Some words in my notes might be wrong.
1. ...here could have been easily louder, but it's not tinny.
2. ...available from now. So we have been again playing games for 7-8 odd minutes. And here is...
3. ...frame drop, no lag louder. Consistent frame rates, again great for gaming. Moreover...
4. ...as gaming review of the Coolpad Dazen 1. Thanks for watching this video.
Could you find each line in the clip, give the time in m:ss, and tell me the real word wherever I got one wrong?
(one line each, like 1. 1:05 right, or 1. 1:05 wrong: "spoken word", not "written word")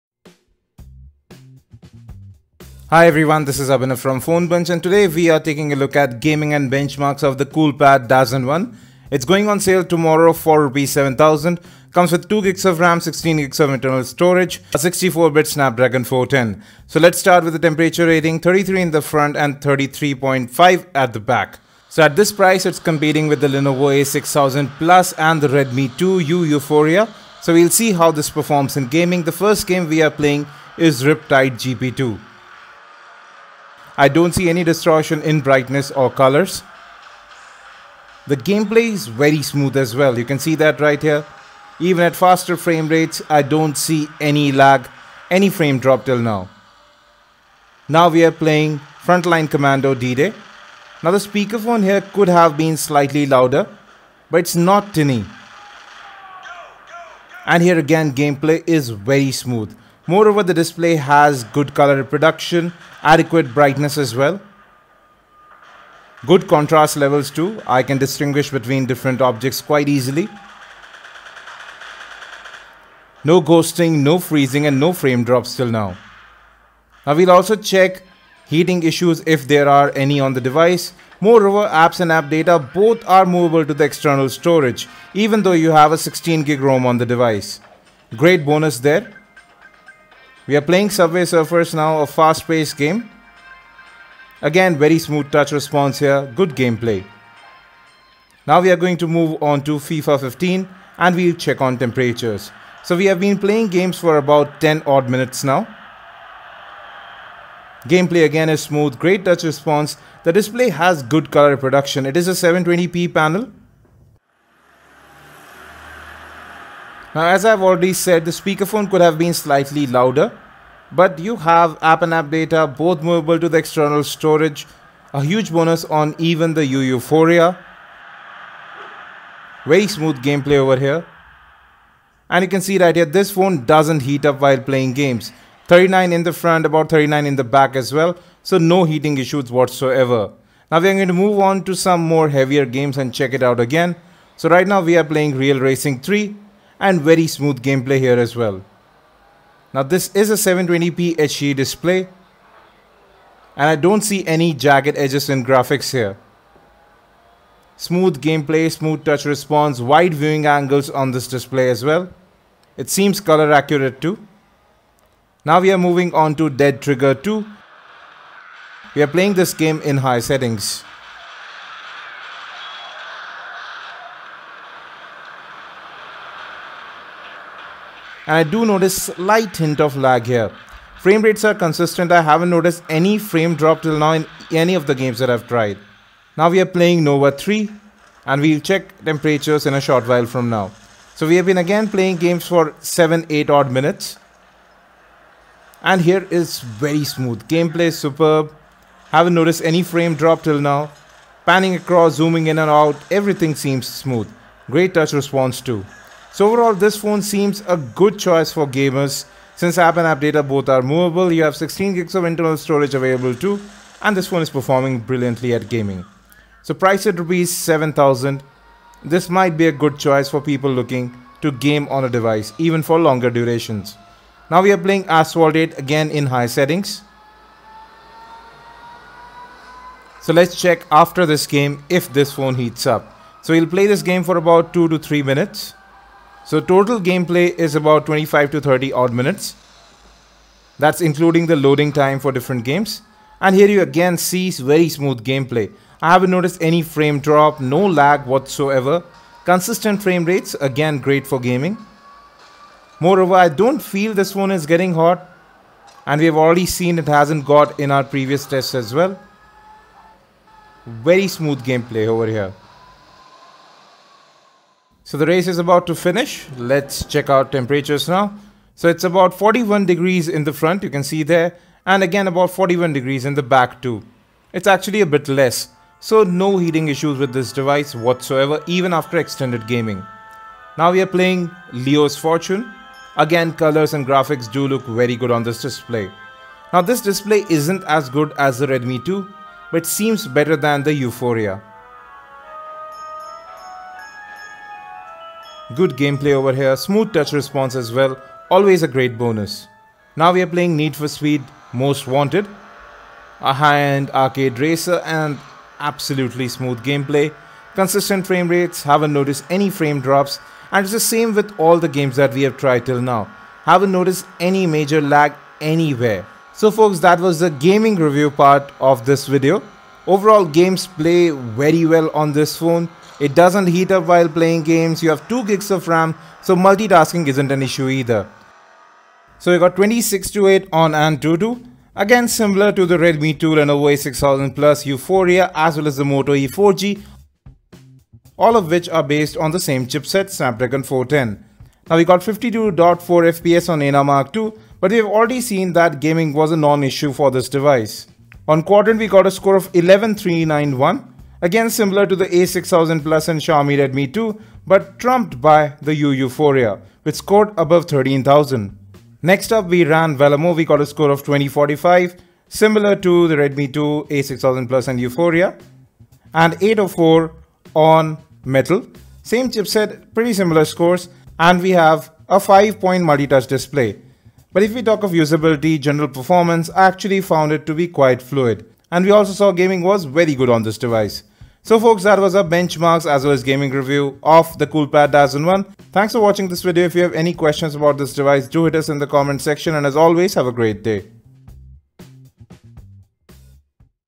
1. 0:51 wrong: "slightly", not "easily"
2. 3:10 wrong: "while", not "available"
3. 4:06 wrong: "whatsoever", not "louder"
4. 6:23 right.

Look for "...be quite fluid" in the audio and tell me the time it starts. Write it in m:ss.
6:17.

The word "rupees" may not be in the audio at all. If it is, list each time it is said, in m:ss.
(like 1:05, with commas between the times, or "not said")
0:10, 3:37.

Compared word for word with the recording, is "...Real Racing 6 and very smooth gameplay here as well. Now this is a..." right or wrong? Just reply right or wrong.
wrong.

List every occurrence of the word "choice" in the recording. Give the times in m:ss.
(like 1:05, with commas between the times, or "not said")
3:28, 3:39.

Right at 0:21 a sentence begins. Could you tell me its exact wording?
So at this price, it's competing with the Lenovo A6000 Plus and the Redmi 2U Yuphoria.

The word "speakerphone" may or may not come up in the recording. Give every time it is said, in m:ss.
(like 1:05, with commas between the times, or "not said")
0:51, 1:58.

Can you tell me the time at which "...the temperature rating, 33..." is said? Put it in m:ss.
0:17.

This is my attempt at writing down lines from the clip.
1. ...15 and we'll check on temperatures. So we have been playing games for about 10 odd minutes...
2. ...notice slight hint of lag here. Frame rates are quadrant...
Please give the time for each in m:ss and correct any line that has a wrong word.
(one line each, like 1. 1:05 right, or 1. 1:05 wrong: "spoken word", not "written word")
1. 1:40 right
2. 2:58 wrong: "consistent", not "quadrant".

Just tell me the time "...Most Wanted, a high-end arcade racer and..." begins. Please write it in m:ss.
5:01.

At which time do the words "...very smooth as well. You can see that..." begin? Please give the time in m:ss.
0:39.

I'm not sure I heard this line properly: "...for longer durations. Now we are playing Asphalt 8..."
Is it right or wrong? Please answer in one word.
right.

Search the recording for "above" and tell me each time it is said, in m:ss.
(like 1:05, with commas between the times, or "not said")
5:57.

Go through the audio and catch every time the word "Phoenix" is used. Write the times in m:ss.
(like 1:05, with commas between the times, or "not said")
not said.